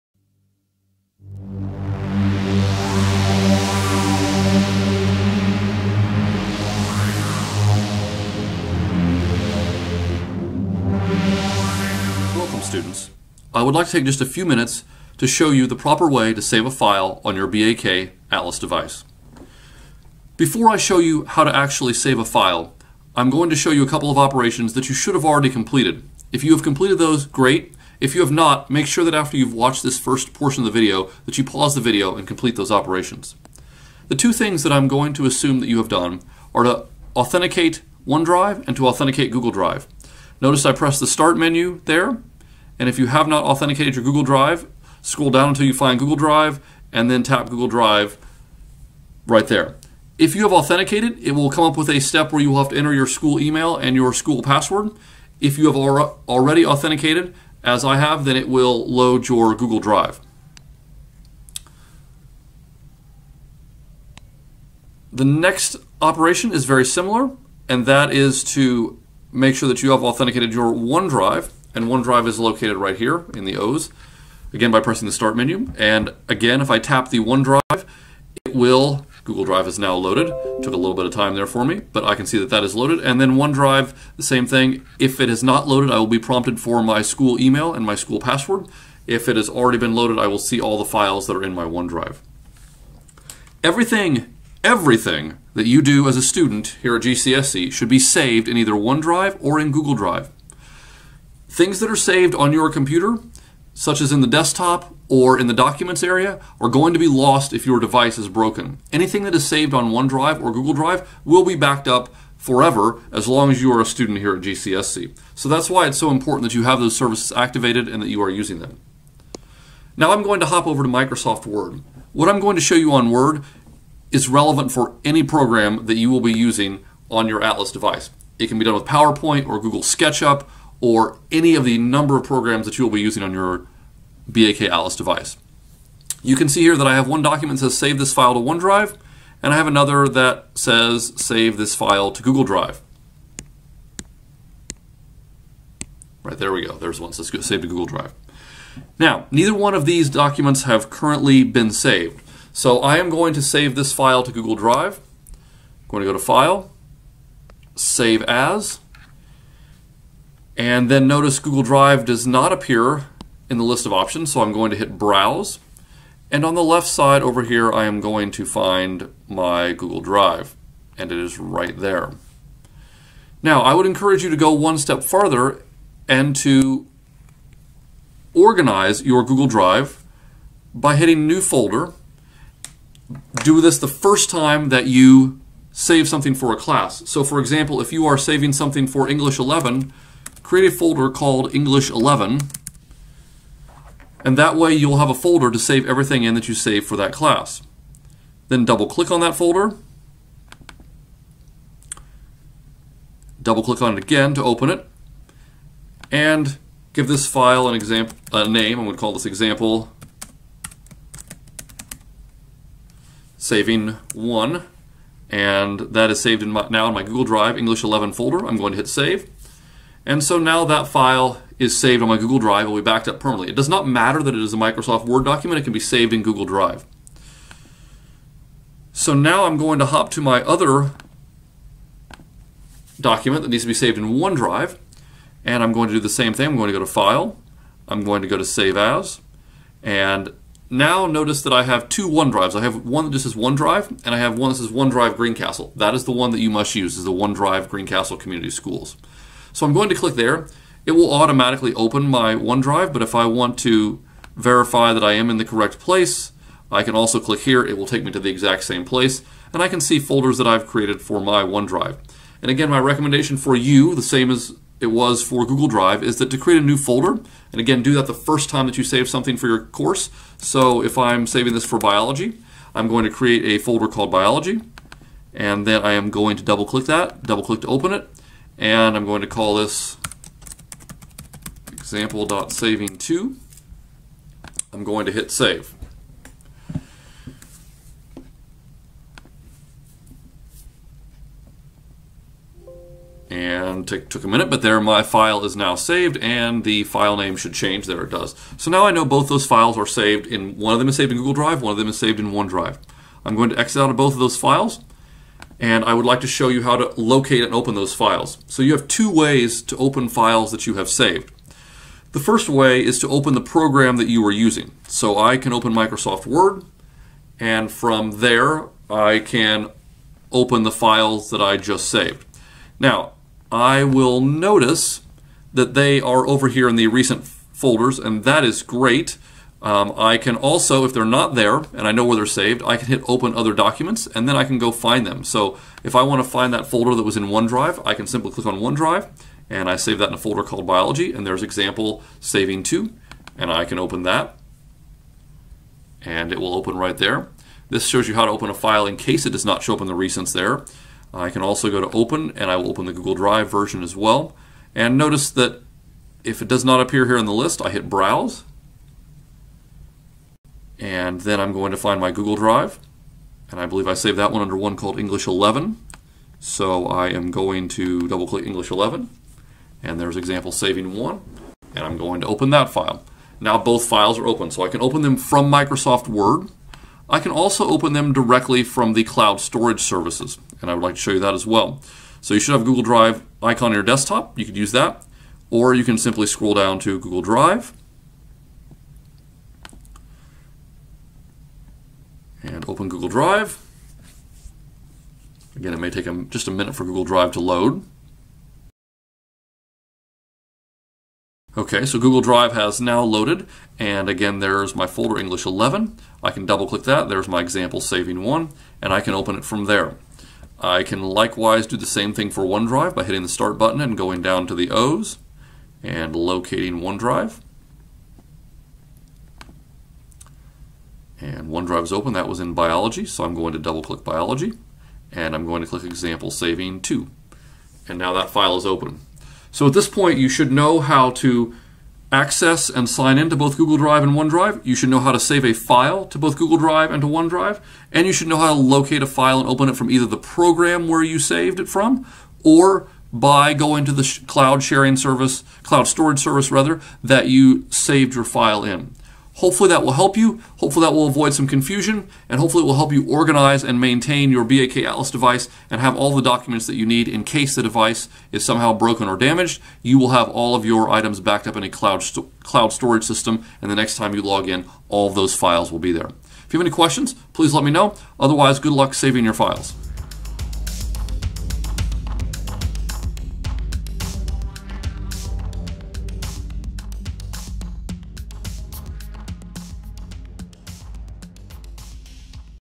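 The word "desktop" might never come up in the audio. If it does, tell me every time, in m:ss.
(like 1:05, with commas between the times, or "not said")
1:44, 6:23.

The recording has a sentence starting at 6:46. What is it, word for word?
I can double click that, there's my example saving one, and I can open it from there.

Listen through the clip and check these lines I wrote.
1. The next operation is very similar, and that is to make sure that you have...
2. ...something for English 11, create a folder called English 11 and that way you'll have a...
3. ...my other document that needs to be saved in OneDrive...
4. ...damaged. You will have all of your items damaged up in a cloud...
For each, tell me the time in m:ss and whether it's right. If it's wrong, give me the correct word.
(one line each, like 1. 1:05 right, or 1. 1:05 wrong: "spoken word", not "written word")
1. 1:05 right
2. 3:08 right
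3. 3:50 right
4. 7:39 wrong: "backed", not "damaged".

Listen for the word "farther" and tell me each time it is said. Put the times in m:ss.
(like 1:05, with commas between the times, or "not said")
2:55.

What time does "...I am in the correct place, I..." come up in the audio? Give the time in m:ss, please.
4:15.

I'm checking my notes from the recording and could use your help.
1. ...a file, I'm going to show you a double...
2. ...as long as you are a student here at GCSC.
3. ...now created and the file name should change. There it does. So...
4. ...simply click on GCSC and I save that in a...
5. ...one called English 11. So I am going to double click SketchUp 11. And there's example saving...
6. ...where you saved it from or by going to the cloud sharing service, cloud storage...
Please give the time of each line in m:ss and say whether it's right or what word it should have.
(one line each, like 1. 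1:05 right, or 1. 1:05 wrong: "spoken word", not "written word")
1. 0:22 wrong: "couple", not "double"
2. 1:53 right
3. 4:55 wrong: "saved", not "created"
4. 5:38 wrong: "OneDrive", not "GCSC"
5. 6:04 wrong: "English", not "SketchUp"
6. 7:20 right.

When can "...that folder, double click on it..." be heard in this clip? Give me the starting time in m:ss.
3:19.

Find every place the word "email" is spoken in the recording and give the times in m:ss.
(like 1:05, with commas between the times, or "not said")
0:53, 1:27.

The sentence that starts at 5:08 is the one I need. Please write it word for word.
So you have two ways to open files that you have saved.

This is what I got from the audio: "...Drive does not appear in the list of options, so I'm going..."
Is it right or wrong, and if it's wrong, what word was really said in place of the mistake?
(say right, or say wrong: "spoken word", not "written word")
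right.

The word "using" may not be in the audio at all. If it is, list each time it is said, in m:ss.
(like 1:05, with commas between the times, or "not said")
1:58, 2:06, 2:12, 5:14.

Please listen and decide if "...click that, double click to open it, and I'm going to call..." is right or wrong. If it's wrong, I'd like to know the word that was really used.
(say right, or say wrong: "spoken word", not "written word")
right.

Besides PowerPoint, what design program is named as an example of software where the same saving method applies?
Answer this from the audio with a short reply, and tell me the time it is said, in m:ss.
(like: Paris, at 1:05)
Google SketchUp, at 2:09.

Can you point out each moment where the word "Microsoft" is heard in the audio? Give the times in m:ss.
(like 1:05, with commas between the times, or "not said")
2:00, 3:44, 5:15, 6:15.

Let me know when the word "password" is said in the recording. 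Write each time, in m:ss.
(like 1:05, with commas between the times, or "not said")
0:54, 1:28.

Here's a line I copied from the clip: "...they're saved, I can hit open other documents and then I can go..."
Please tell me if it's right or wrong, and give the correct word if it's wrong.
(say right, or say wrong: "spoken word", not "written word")
right.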